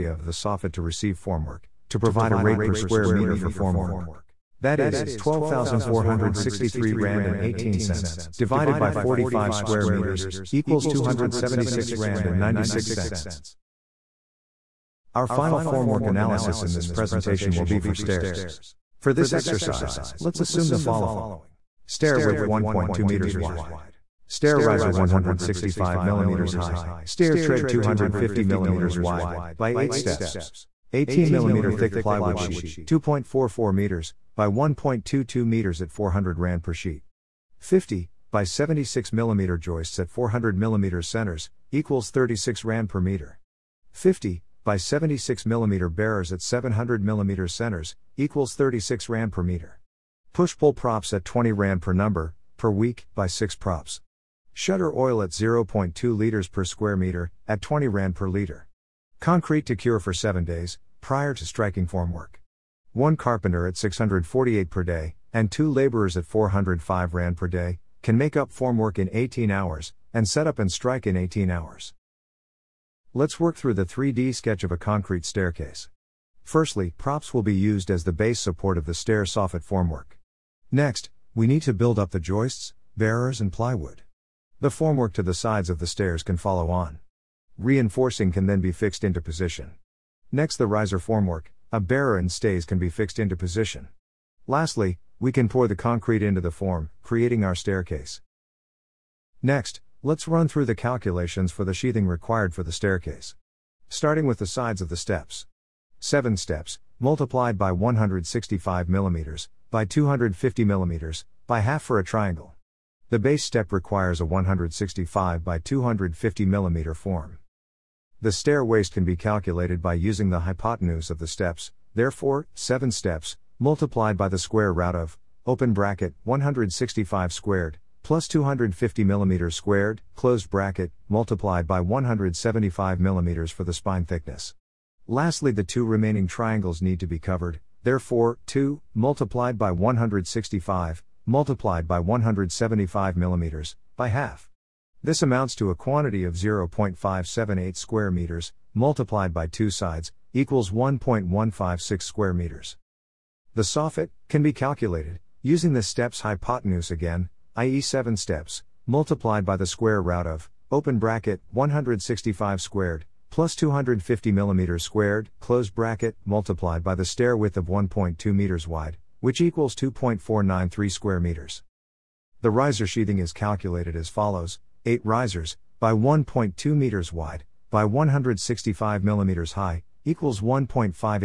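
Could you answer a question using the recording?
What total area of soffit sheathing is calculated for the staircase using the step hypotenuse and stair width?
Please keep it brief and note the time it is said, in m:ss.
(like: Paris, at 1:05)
2.493 square meters, at 2:49.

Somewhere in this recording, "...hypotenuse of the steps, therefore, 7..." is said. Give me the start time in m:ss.
2:00.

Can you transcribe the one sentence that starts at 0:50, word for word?
Push pull props at 20 rand per number, per week, by 6 props.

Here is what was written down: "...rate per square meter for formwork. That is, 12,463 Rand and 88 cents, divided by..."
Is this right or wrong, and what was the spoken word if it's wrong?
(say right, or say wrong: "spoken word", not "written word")
wrong: "18", not "88".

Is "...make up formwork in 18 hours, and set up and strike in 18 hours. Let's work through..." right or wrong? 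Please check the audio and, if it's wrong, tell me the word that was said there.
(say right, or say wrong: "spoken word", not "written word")
right.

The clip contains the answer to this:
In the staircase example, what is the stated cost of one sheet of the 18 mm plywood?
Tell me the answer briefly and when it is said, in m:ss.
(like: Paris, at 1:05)
400 Rand per sheet, at 0:35.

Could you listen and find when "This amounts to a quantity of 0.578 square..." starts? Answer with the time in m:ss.
2:25.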